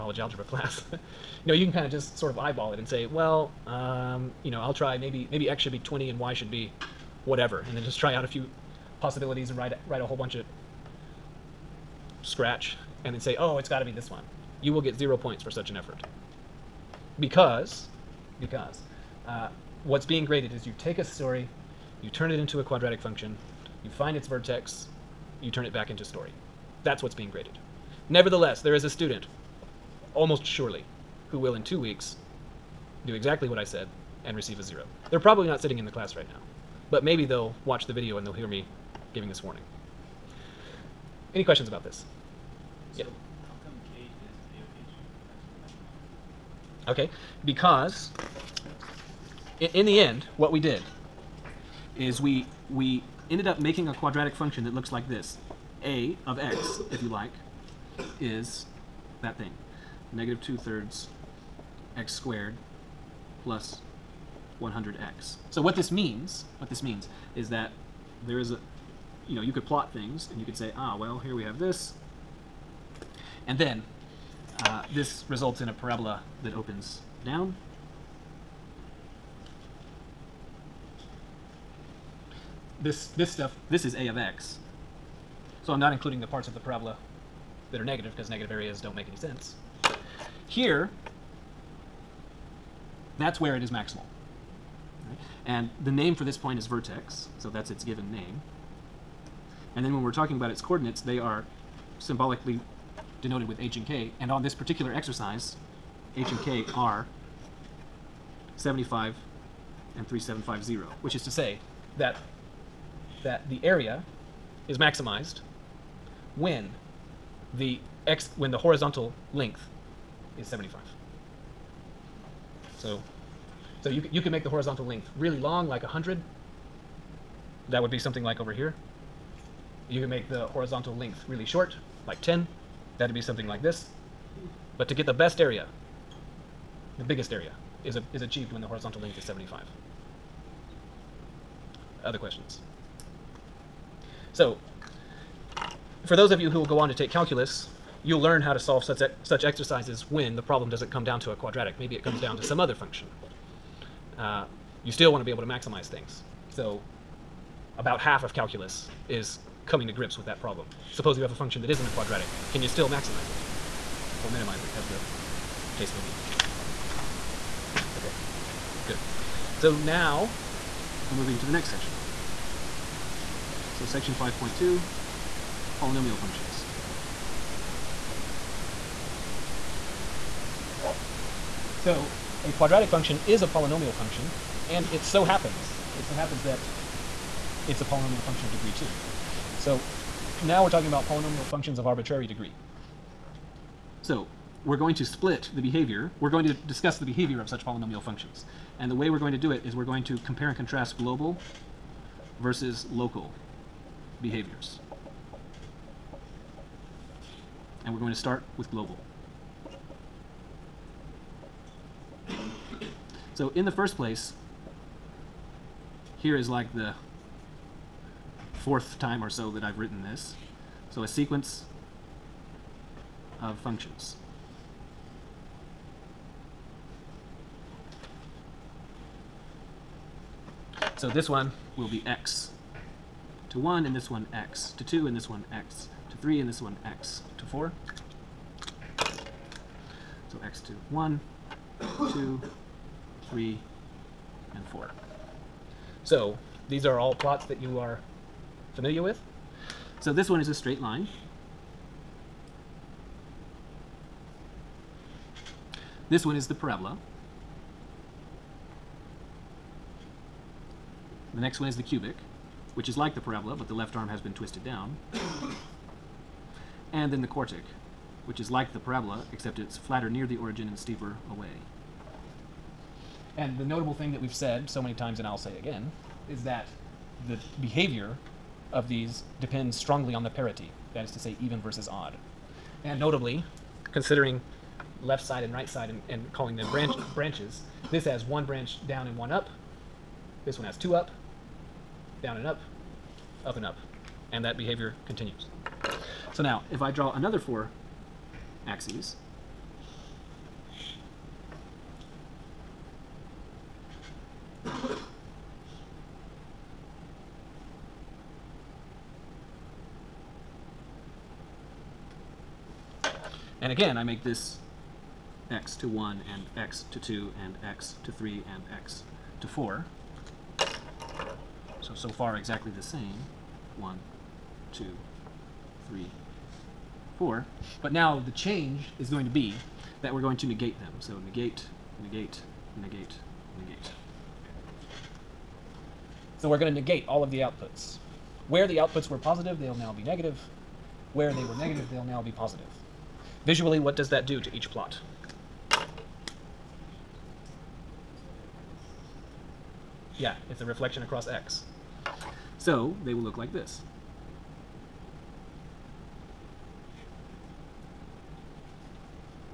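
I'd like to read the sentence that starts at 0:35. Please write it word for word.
They're probably not sitting in the class right now, but maybe they'll watch the video and they'll hear me giving this warning.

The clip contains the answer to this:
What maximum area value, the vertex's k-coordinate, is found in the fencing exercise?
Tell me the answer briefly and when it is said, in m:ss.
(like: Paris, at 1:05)
3750, at 1:50.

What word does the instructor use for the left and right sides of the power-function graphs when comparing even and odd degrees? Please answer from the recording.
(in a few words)
branches.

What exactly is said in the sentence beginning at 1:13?
And then uh, this results in a parabola that opens down.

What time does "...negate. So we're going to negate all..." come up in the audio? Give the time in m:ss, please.
5:33.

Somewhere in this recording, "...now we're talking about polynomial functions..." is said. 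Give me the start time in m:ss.
3:10.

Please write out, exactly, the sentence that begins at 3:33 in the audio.
So in the first place, here is like the fourth time or so that I've written this.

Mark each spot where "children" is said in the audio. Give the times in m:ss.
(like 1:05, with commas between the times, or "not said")
not said.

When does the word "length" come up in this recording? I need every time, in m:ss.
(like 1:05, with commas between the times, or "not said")
1:59, 2:04, 2:10, 2:18.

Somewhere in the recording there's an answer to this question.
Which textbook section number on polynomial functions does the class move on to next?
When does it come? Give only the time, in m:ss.
2:54.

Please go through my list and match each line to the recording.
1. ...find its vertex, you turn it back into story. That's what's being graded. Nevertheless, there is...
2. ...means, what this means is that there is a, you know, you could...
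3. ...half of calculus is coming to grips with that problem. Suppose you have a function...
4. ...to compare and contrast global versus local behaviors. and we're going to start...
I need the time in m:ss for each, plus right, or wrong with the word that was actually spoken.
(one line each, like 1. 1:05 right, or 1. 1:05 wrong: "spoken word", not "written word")
1. 0:23 right
2. 1:05 right
3. 2:37 right
4. 3:20 right.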